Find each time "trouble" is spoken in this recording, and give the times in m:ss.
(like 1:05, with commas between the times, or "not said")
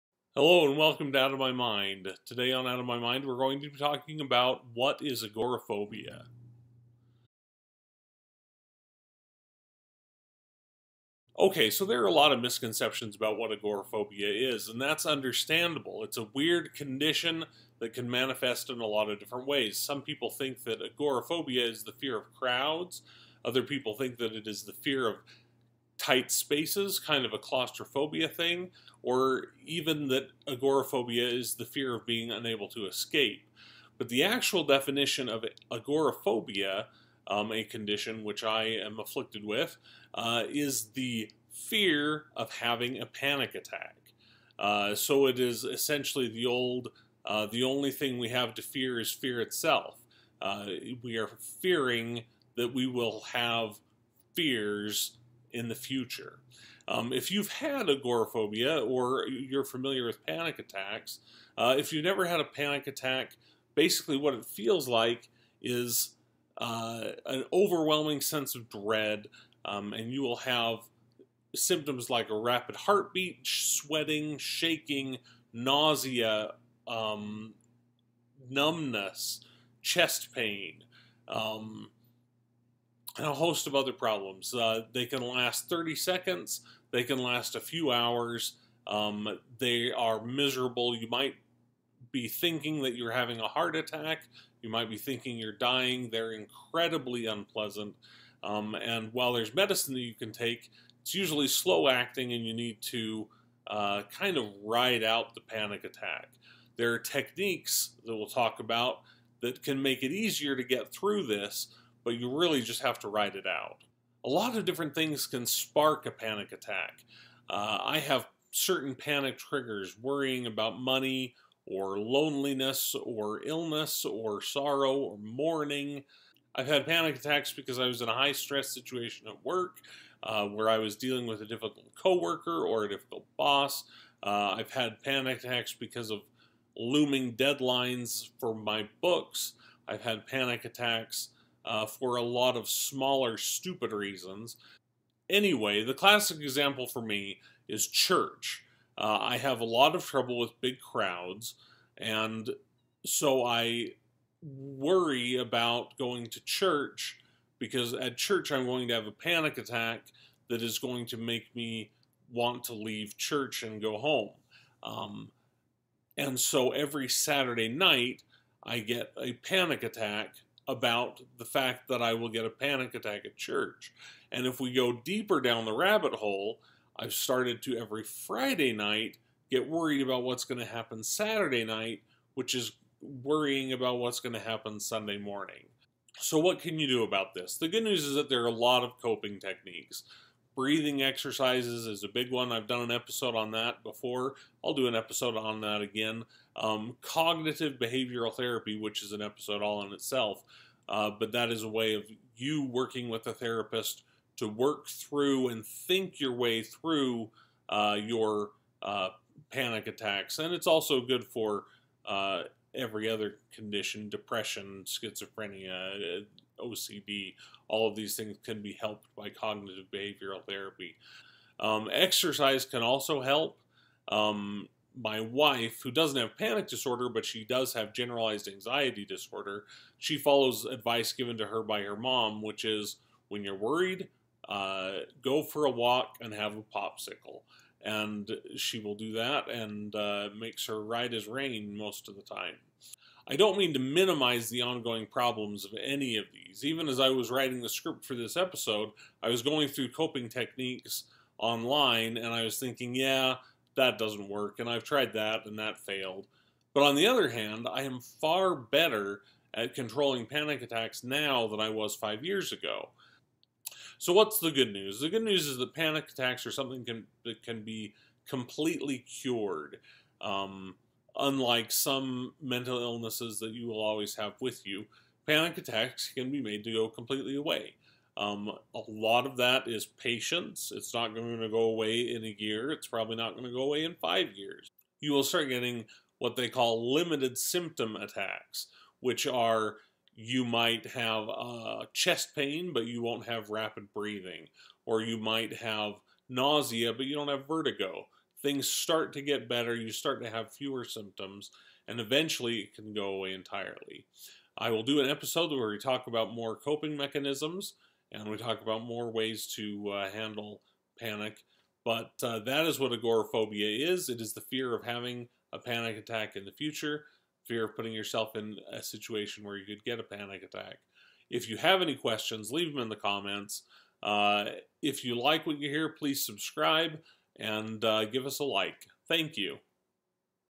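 2:30.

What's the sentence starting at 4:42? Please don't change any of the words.
It's probably not going to go away in five years.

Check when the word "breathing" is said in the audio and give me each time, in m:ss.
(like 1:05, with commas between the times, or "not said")
3:10, 4:53.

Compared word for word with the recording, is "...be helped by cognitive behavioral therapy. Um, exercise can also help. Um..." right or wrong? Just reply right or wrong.
right.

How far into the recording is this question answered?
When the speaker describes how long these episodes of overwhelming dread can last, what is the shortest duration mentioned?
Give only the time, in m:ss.
1:25.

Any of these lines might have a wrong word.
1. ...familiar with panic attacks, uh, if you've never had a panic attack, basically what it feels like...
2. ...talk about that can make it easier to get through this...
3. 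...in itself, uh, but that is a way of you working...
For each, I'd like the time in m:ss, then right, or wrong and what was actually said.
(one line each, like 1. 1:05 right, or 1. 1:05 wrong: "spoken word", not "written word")
1. 0:59 right
2. 1:48 right
3. 3:19 right.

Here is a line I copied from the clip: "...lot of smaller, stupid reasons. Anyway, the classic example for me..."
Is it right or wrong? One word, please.
right.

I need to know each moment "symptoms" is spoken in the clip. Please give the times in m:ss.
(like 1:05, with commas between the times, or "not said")
1:11, 4:47, 5:00.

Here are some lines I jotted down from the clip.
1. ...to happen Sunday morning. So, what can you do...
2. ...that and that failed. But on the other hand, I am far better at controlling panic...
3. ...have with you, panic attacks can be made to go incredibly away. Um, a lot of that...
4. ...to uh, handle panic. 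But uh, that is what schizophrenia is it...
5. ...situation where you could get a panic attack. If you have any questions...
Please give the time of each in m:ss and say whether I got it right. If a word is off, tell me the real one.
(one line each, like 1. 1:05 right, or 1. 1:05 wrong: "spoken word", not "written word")
1. 3:04 right
2. 4:15 right
3. 4:34 wrong: "completely", not "incredibly"
4. 5:09 wrong: "agoraphobia", not "schizophrenia"
5. 5:18 right.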